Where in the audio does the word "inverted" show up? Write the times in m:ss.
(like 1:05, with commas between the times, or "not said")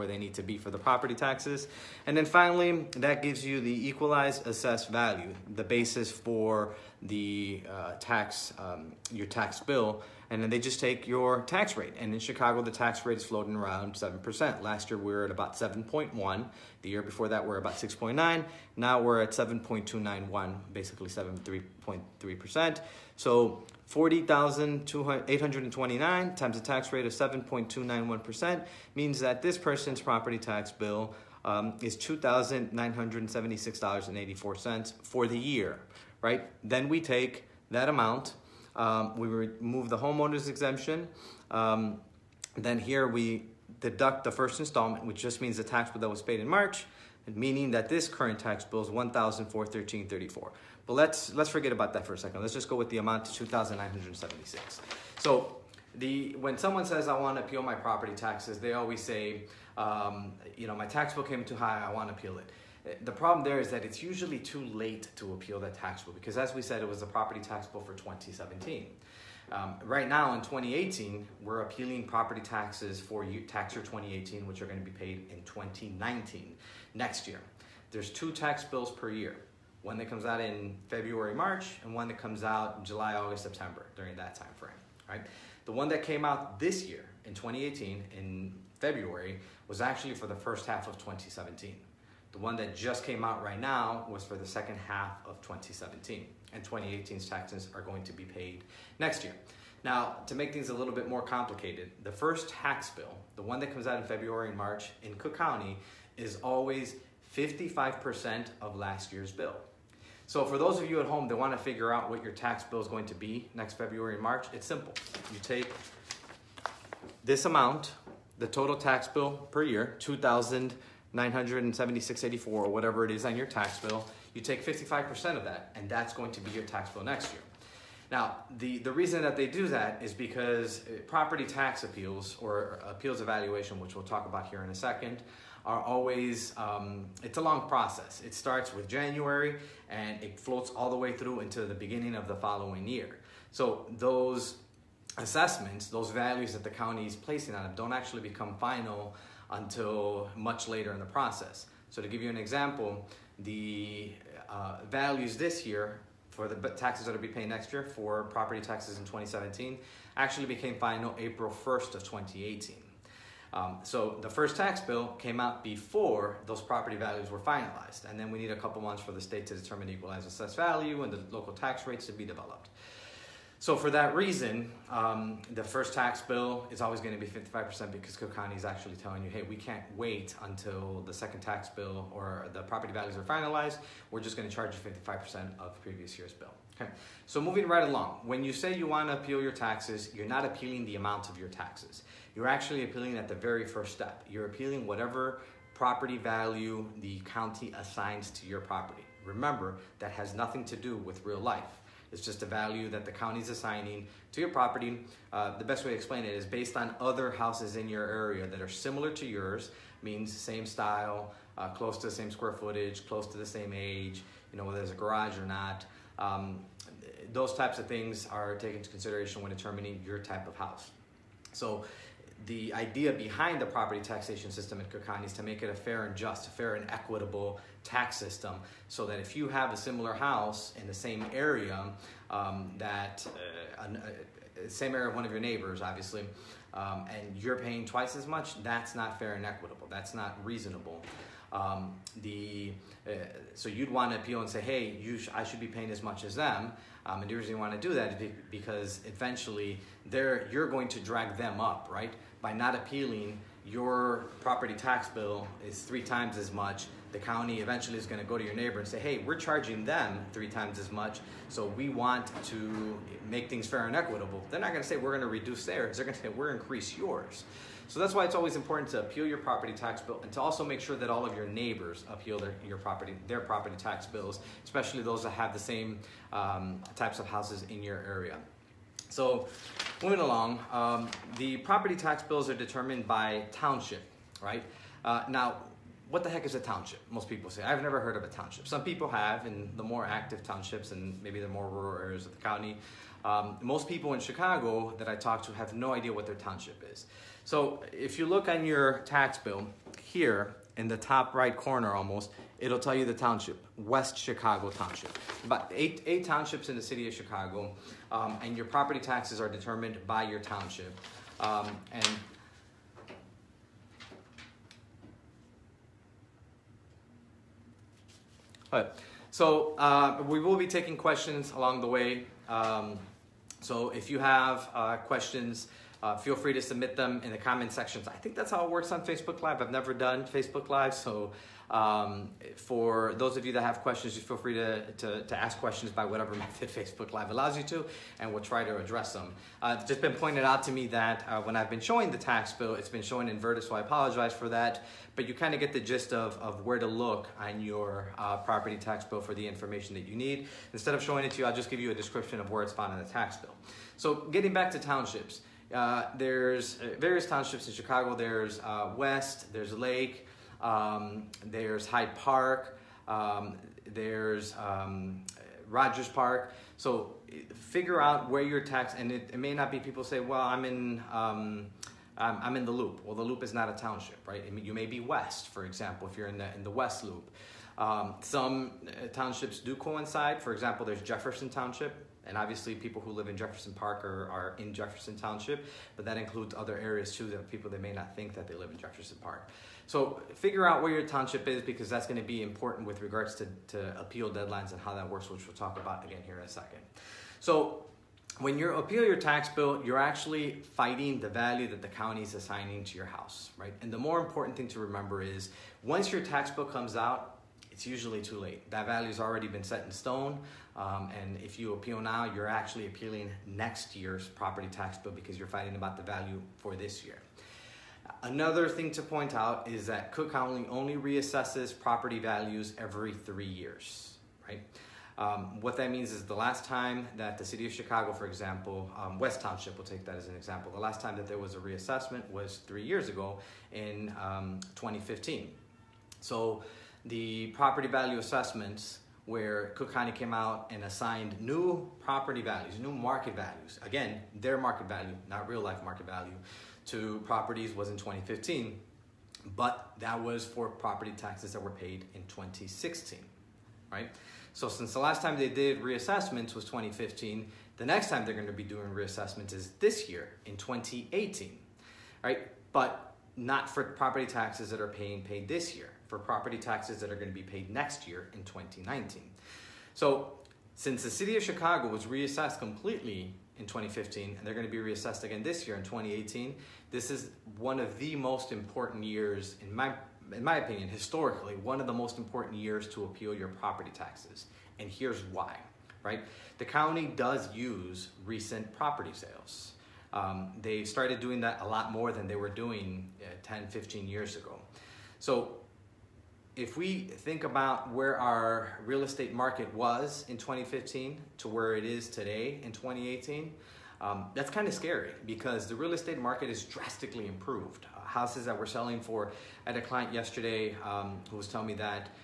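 5:43.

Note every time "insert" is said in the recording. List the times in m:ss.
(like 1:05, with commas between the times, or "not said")
not said.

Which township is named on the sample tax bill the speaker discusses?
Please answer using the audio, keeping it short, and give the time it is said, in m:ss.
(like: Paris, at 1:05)
West Chicago Township, at 5:03.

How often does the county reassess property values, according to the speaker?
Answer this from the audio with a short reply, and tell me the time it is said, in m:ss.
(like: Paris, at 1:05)
every 3 years, at 7:02.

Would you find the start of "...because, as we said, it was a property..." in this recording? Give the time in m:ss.
1:06.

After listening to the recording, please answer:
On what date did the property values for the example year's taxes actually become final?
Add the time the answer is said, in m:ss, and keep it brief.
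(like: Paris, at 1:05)
April 1st of 2018, at 2:41.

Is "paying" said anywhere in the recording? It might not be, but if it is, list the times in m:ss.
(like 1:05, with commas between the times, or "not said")
3:57, 4:05, 7:44.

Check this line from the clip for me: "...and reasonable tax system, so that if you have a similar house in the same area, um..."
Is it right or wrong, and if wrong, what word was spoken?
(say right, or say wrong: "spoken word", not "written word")
wrong: "equitable", not "reasonable".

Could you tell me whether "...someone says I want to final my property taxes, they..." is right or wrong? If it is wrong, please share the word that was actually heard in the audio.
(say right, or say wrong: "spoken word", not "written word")
wrong: "appeal", not "final".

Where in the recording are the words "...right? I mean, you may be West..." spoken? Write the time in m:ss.
6:14.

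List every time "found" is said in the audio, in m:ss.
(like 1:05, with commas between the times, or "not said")
5:52.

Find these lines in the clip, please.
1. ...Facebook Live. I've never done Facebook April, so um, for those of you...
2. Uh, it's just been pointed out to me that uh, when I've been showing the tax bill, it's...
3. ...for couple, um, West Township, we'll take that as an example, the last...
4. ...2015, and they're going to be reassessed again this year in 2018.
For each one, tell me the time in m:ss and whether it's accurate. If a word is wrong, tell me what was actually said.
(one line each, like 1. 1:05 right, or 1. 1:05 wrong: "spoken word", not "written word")
1. 5:29 wrong: "Live", not "April"
2. 5:39 right
3. 7:08 wrong: "example", not "couple"
4. 7:53 right.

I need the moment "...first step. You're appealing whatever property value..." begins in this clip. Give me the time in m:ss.
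3:13.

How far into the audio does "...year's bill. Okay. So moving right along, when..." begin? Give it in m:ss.
3:06.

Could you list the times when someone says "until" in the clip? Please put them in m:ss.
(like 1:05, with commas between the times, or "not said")
2:29, 3:00.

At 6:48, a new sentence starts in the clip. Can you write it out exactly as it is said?
That value's already been set in stone.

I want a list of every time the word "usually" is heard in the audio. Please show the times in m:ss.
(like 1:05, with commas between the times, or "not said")
1:04, 6:47.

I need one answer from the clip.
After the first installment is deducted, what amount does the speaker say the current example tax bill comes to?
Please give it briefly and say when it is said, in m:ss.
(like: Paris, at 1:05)
1,413.34, at 0:48.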